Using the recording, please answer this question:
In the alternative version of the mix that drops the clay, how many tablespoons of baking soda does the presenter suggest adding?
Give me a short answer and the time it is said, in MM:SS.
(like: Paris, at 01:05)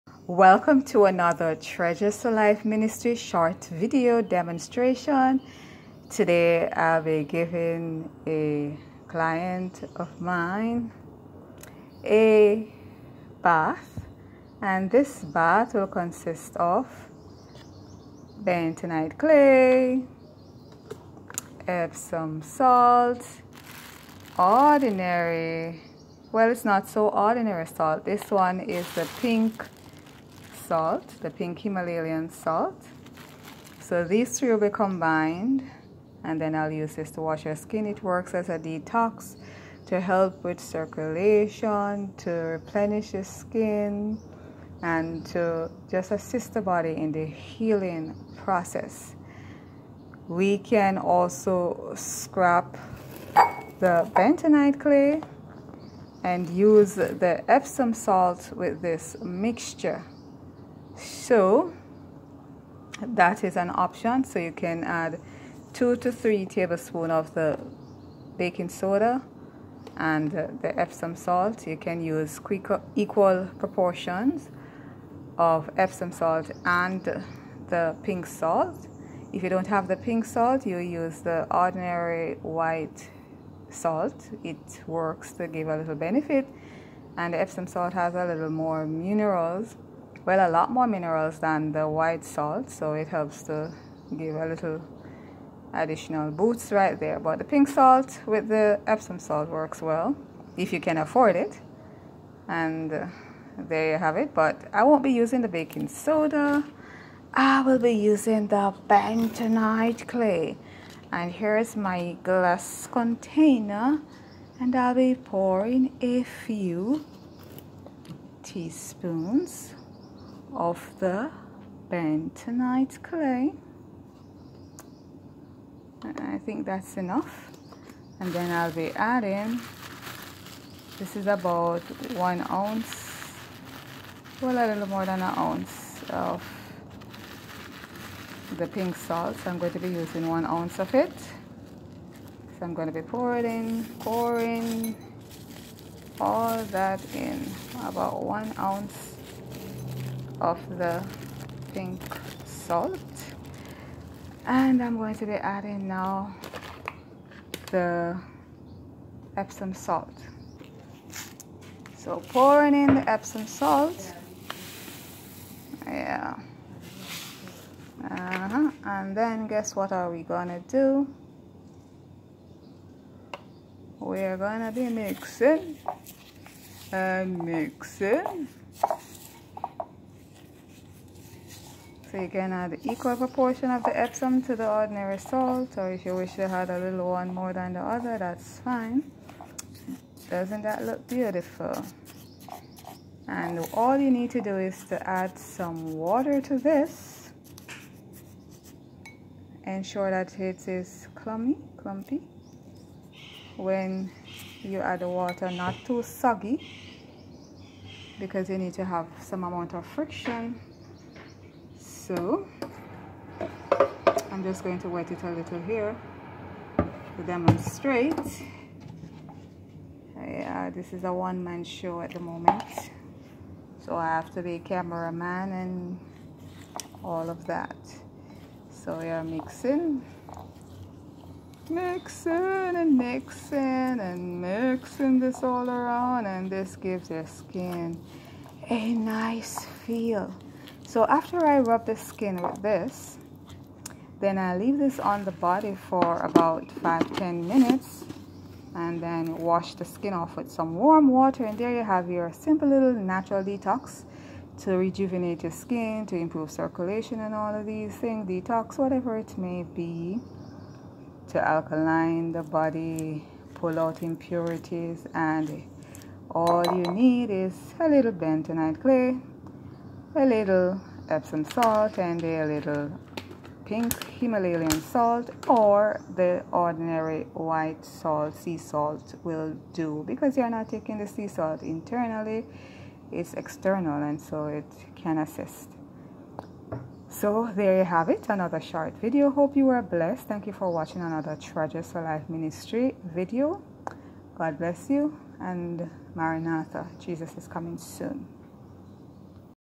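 2 to 3, at 01:05.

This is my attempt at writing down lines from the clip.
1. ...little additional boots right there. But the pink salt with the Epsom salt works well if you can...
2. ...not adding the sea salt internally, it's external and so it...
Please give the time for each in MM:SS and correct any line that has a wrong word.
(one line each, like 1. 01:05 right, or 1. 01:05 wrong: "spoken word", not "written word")
1. 01:34 right
2. 04:40 wrong: "taking", not "adding".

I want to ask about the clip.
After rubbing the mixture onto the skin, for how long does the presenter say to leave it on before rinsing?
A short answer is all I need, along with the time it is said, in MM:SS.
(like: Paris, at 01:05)
5-10 minutes, at 04:06.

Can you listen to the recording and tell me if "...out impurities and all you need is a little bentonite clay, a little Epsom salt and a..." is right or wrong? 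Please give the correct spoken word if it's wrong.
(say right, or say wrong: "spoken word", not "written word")
right.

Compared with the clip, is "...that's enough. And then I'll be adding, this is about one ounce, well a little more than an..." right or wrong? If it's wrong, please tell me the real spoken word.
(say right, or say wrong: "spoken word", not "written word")
right.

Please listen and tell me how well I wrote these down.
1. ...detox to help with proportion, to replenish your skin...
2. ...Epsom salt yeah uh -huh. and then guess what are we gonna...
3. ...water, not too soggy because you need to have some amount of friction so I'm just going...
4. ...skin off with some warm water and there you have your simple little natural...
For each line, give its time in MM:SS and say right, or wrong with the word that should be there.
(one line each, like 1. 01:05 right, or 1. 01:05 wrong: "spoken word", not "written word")
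1. 00:38 wrong: "circulation", not "proportion"
2. 02:43 right
3. 03:25 right
4. 04:09 right.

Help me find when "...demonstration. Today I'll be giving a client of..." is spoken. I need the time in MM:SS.
00:04.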